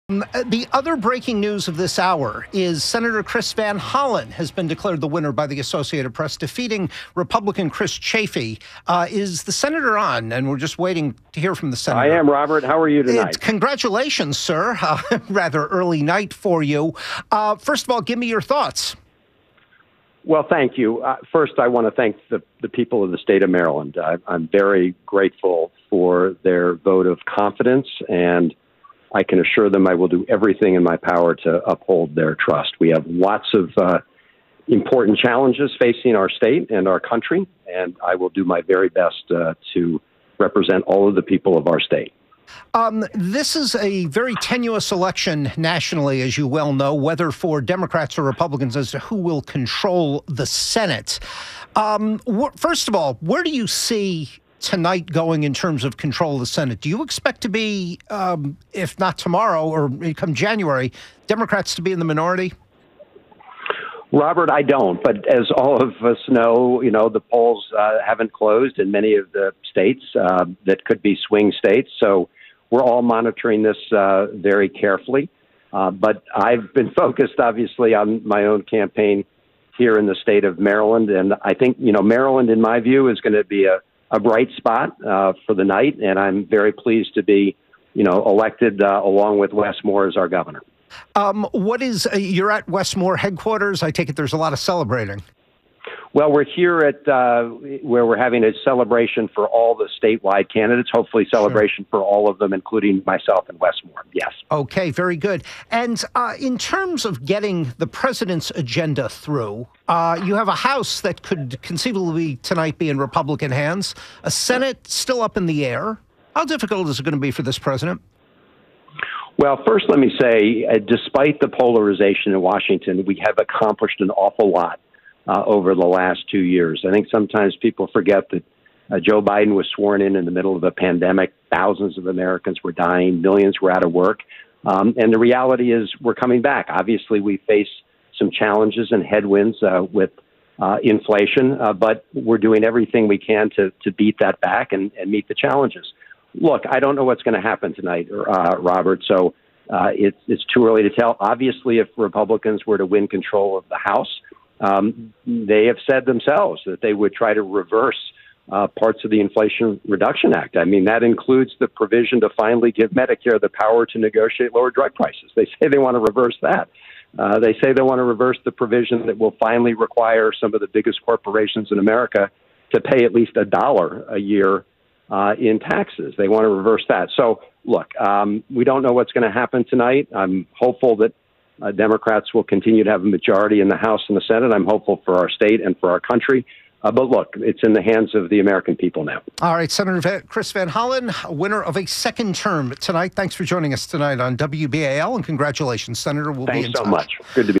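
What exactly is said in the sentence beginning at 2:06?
I think sometimes people forget that uh, Joe Biden was sworn in in the middle of a pandemic.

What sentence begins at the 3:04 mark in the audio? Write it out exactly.
I'm hopeful for our state and for our country.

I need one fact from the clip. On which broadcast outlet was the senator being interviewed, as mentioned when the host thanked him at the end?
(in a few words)
WBAL.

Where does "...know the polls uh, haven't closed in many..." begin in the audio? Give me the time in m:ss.
1:06.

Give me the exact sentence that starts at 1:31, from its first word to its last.
Um, what is uh, you're at Wes Moore headquarters?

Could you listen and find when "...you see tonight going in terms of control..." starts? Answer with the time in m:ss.
0:53.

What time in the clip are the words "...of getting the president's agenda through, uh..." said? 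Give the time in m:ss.
1:47.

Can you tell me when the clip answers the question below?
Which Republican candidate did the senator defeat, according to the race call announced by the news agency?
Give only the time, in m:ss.
0:07.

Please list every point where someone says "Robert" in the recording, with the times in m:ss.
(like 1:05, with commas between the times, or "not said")
0:12, 1:04, 2:28.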